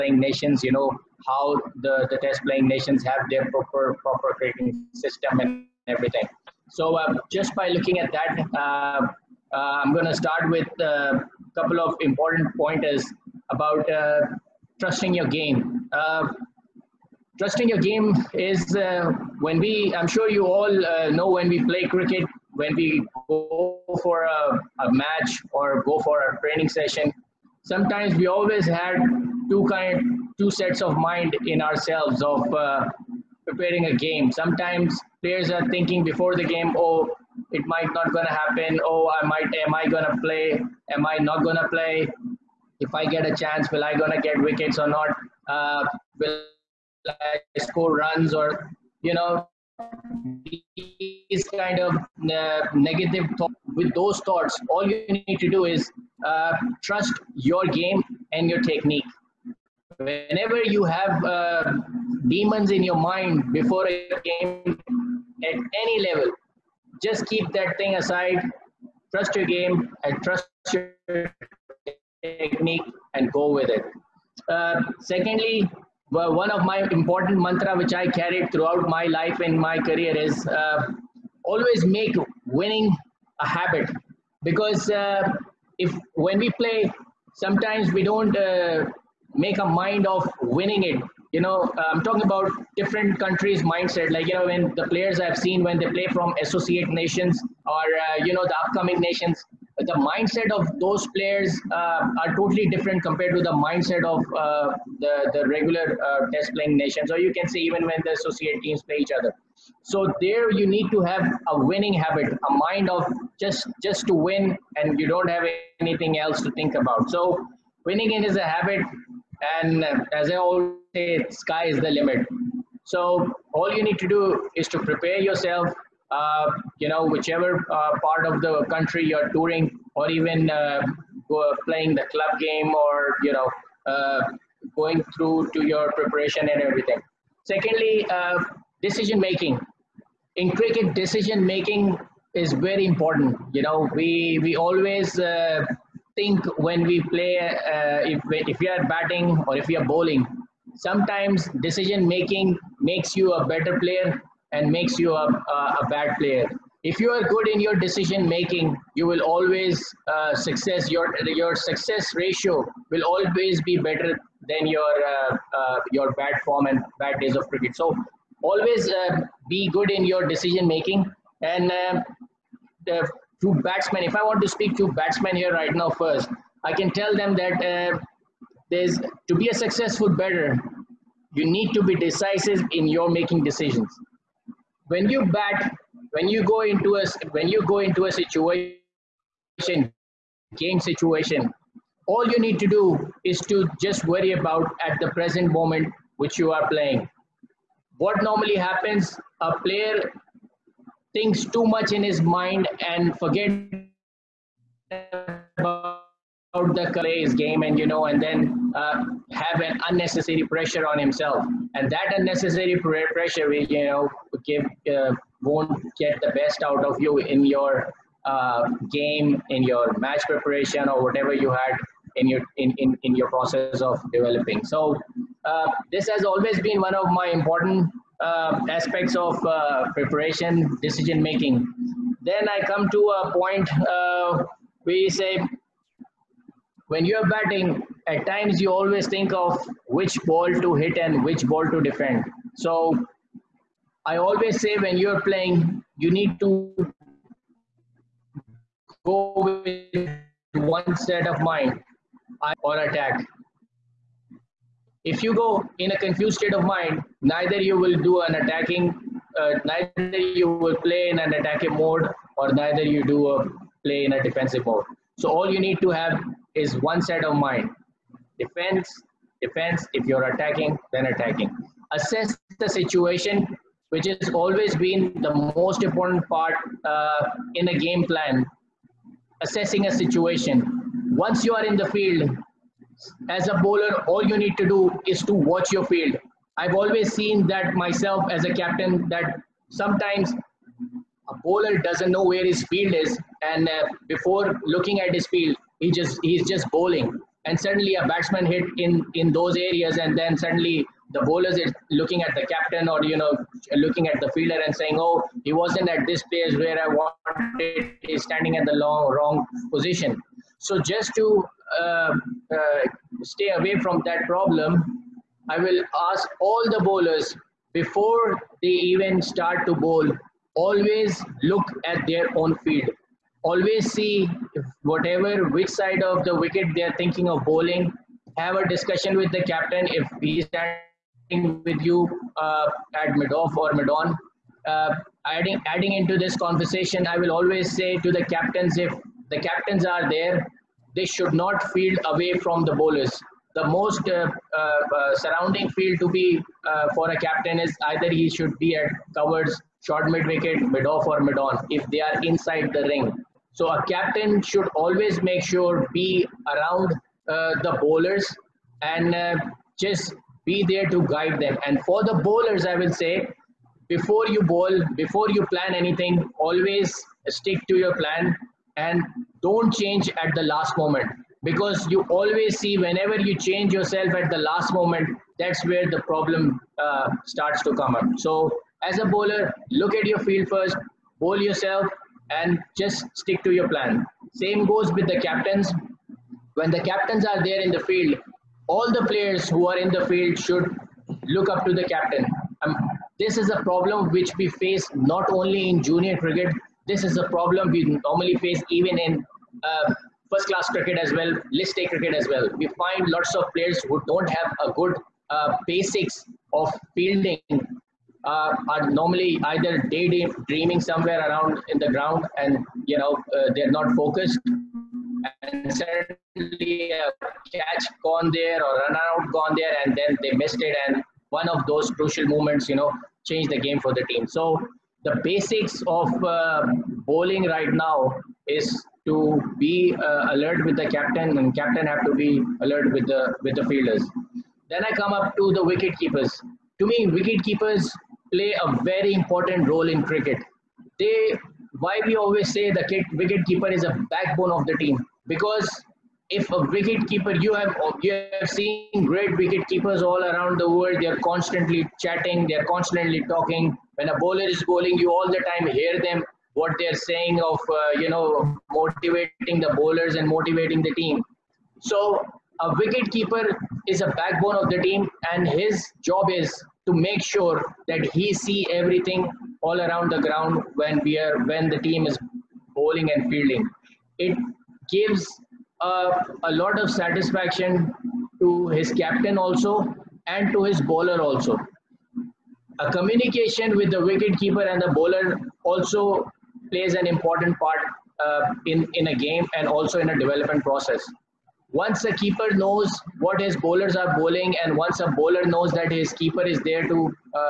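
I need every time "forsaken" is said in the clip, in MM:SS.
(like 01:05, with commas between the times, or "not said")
not said.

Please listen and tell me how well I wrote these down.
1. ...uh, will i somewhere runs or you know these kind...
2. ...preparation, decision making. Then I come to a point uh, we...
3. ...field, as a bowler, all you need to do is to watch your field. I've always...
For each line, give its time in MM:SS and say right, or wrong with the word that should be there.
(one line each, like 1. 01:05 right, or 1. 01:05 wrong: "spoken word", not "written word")
1. 00:45 wrong: "score", not "somewhere"
2. 03:49 right
3. 04:41 right.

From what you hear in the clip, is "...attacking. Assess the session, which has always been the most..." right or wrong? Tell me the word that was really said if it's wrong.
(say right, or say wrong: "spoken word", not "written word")
wrong: "situation", not "session".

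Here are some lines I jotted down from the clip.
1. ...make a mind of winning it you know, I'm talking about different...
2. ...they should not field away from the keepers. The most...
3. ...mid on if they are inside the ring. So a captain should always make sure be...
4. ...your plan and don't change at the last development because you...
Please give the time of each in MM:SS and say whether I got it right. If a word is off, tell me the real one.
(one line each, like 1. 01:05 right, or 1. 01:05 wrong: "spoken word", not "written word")
1. 01:29 right
2. 05:40 wrong: "bowlers", not "keepers"
3. 05:51 right
4. 06:07 wrong: "moment", not "development".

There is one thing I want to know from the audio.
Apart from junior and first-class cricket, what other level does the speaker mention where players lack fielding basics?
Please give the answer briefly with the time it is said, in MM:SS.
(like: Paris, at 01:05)
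List A cricket, at 06:41.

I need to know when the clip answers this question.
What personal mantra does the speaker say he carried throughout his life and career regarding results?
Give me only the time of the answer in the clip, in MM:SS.
01:21.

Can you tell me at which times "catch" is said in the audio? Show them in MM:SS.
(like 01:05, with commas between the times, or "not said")
06:57.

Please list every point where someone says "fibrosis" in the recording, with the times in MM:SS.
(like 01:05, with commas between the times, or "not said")
not said.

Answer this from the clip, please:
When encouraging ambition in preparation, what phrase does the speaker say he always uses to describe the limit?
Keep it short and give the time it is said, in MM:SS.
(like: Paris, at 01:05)
Sky is the limit, at 02:01.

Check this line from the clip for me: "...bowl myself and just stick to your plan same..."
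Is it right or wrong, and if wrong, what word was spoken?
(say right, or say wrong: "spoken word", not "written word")
wrong: "yourself", not "myself".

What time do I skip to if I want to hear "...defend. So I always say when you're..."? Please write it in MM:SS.
04:01.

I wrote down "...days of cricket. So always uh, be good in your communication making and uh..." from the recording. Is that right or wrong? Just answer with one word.
wrong.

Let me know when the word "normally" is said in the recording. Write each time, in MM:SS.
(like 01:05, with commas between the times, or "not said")
03:18, 06:37, 06:48.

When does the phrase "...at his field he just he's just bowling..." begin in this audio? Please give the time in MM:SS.
04:54.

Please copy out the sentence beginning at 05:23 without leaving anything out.
Always see whatever, which side of the wicket they are thinking of bowling.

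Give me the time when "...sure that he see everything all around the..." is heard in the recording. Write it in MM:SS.
07:47.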